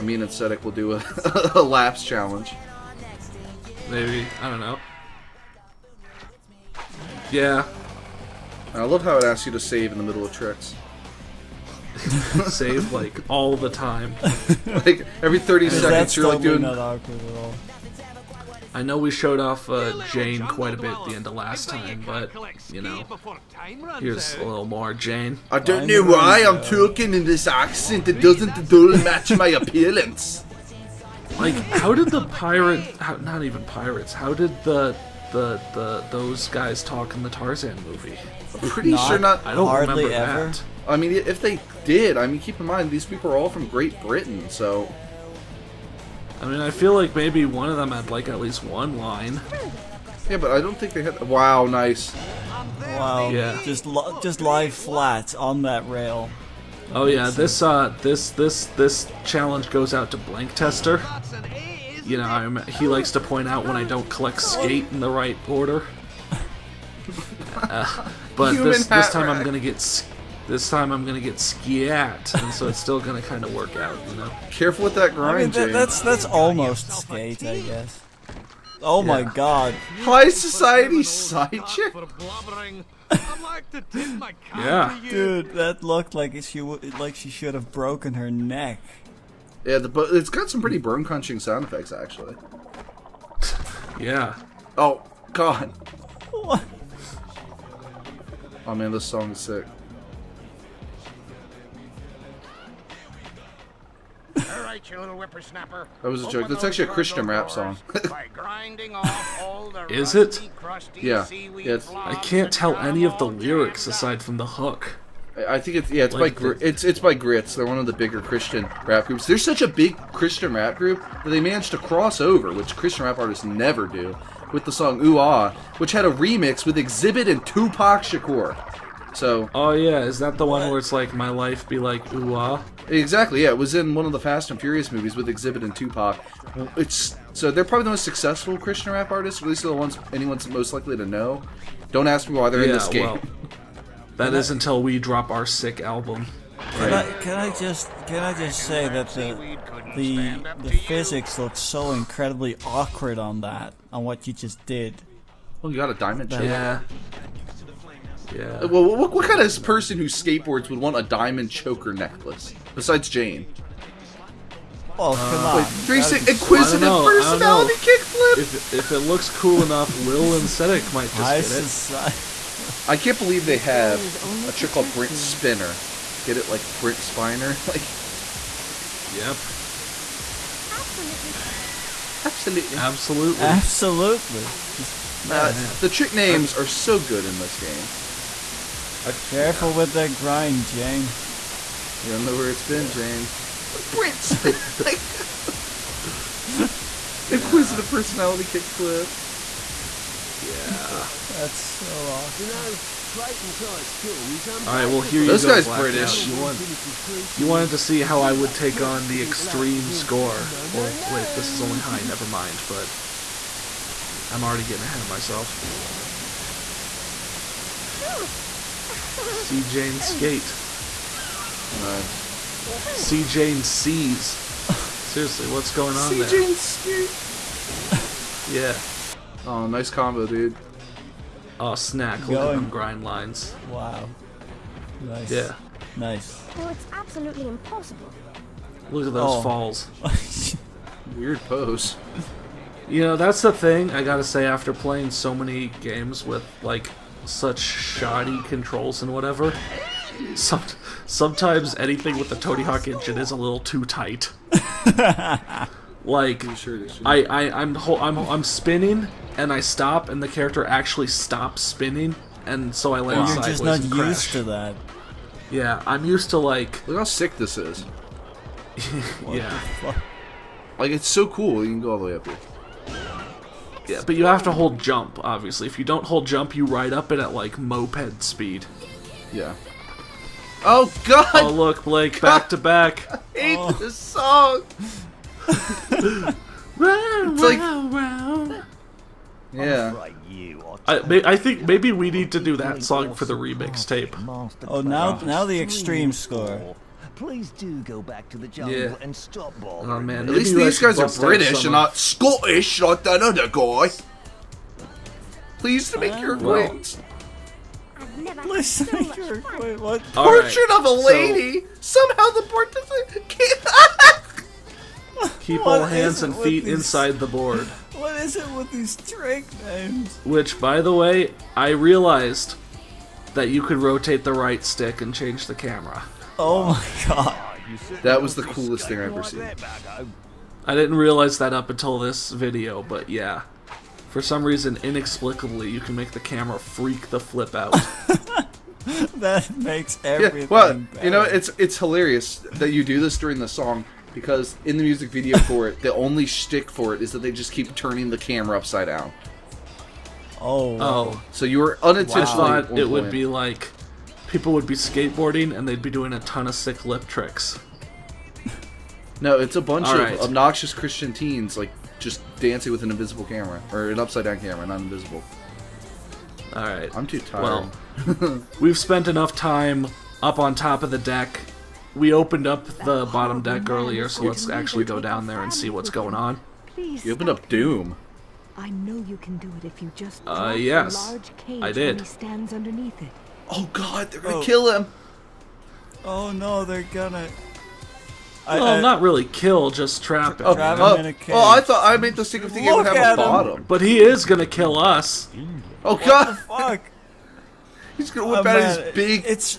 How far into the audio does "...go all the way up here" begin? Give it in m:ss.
4:31.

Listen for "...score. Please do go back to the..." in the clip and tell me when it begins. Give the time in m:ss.
4:56.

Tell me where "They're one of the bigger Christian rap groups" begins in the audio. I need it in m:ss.
1:57.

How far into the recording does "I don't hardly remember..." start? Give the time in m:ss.
0:39.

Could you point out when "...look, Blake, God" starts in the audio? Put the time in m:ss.
4:41.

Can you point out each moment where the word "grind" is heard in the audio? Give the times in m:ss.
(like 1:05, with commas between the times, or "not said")
1:15, 3:10, 3:52.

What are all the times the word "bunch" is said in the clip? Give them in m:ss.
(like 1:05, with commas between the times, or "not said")
5:59.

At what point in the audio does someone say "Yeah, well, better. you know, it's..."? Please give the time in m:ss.
5:40.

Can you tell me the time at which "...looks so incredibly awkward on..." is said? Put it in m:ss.
2:31.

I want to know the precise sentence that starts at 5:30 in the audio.
I didn't realize that up until this video, but yeah.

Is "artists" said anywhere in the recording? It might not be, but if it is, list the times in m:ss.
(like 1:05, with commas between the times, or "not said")
2:03, 2:19.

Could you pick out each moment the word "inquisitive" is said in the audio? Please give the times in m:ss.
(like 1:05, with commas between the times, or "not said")
2:46, 3:17.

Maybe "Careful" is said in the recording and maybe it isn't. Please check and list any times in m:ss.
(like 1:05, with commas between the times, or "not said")
1:14, 3:09.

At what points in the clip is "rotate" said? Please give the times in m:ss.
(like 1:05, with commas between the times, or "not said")
5:23.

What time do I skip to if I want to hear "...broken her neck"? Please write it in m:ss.
1:27.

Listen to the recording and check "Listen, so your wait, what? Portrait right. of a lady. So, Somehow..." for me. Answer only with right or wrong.
right.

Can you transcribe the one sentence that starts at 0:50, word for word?
Yeah, but I don't think they had.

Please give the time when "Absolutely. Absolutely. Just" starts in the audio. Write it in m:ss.
3:02.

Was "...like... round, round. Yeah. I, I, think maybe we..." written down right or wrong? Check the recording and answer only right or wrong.
right.